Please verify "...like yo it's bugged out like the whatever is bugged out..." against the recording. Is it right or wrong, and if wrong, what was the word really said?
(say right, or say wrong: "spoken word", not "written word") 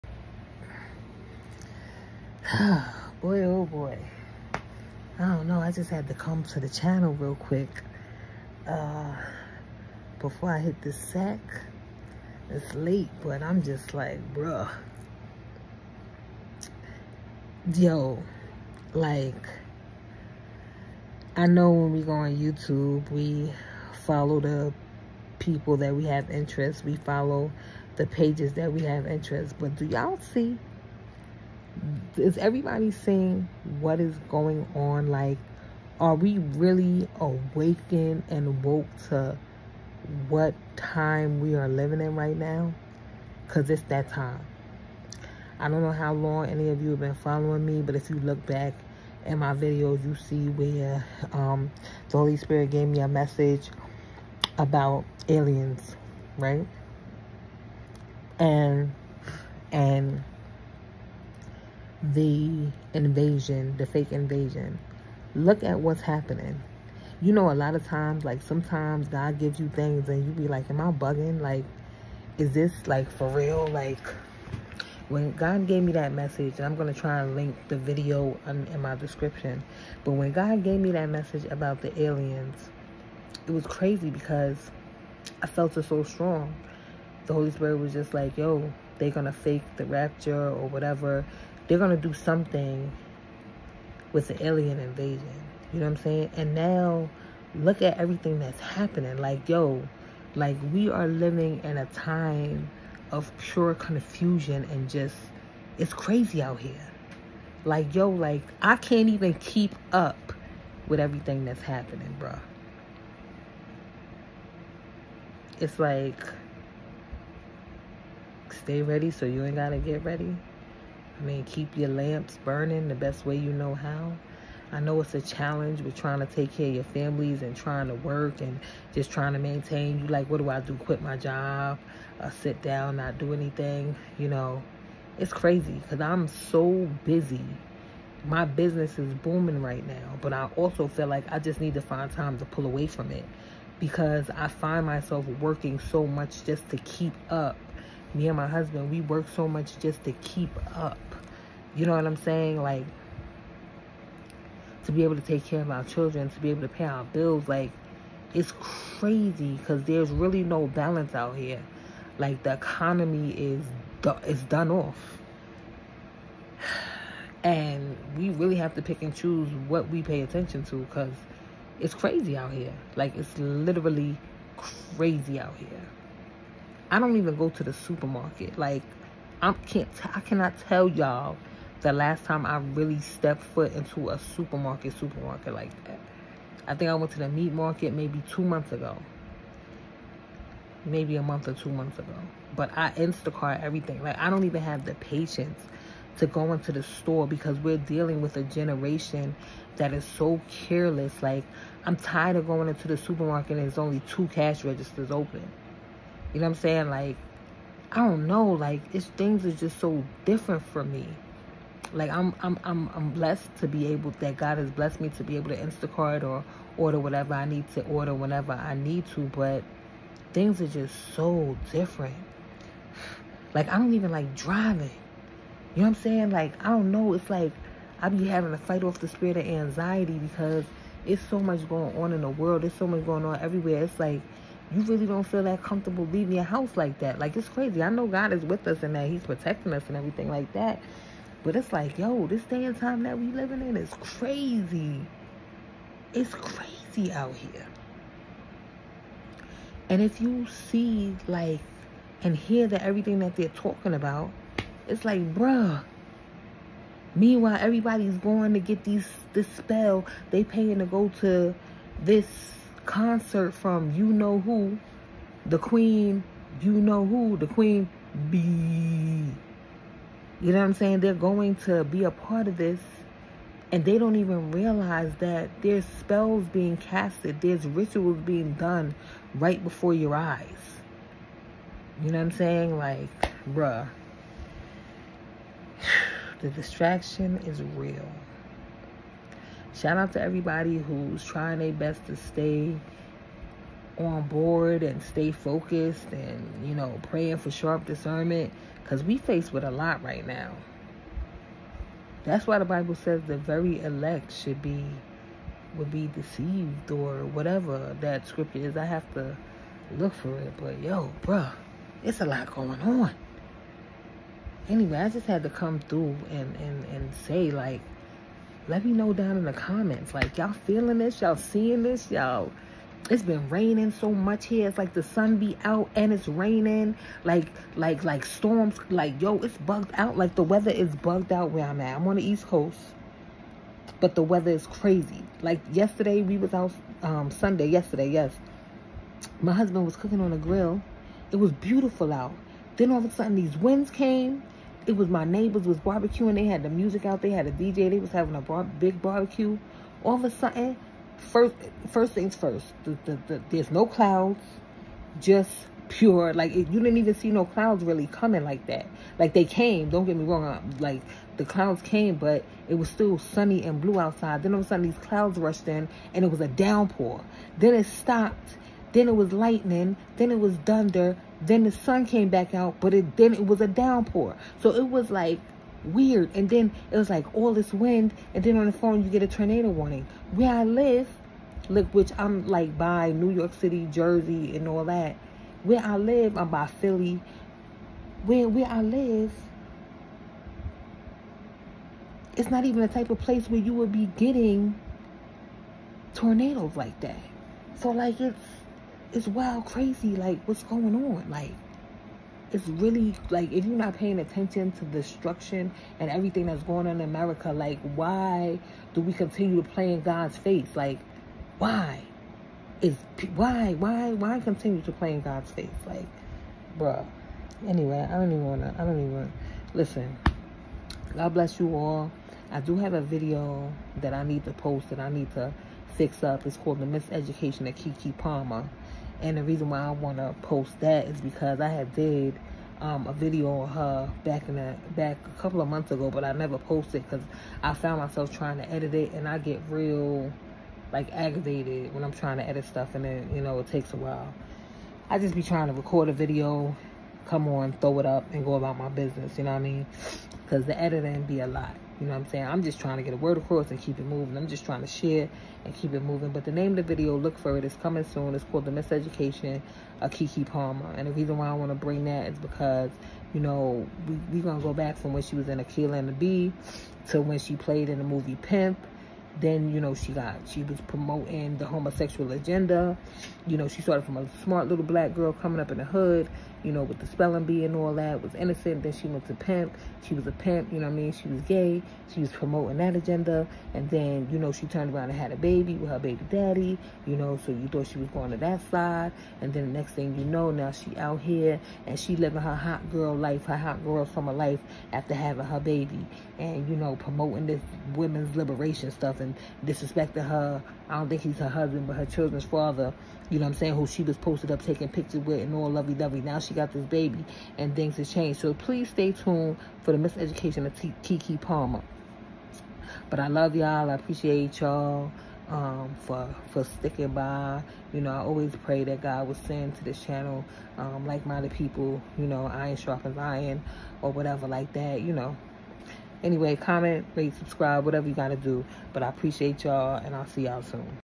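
wrong: "weather", not "whatever".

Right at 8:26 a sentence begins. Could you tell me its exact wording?
Now she she got this baby and things have changed.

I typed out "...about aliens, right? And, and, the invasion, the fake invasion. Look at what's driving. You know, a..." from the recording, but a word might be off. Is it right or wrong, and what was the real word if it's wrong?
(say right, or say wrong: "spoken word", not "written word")
wrong: "happening", not "driving".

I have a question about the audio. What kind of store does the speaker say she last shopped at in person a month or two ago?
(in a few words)
meat market.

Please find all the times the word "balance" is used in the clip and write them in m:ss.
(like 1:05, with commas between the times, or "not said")
2:40.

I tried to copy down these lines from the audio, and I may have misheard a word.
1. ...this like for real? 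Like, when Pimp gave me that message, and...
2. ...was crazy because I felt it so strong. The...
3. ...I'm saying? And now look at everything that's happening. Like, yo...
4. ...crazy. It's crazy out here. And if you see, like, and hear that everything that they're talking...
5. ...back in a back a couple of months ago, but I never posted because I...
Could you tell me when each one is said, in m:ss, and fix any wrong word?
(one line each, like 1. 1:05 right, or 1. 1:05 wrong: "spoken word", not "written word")
1. 1:12 wrong: "God", not "Pimp"
2. 1:23 right
3. 1:35 right
4. 4:03 right
5. 7:14 right.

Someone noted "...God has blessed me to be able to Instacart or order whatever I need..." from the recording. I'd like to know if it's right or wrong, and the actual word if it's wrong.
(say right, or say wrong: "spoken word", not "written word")
right.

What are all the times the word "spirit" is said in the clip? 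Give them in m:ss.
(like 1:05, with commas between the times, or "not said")
0:52, 1:27, 3:49.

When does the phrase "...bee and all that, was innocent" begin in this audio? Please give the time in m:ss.
7:57.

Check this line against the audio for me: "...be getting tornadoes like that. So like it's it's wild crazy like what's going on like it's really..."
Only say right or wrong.
right.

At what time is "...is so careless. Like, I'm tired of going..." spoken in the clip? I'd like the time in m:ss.
3:19.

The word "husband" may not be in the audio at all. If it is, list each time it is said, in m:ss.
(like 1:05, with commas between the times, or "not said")
2:28, 5:39, 8:21.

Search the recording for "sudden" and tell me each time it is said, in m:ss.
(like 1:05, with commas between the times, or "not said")
5:43, 5:50, 6:04.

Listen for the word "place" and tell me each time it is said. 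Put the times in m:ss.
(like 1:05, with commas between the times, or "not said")
6:33.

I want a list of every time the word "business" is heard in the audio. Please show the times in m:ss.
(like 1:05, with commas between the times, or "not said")
2:18, 7:28.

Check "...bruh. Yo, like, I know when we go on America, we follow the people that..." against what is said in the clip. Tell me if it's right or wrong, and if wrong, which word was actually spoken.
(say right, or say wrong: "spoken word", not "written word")
wrong: "YouTube", not "America".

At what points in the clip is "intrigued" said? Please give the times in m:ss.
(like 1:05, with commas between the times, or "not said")
not said.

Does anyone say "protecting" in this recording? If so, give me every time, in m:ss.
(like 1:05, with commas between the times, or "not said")
3:59.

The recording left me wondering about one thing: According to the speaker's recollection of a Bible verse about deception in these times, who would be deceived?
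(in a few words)
the very elect.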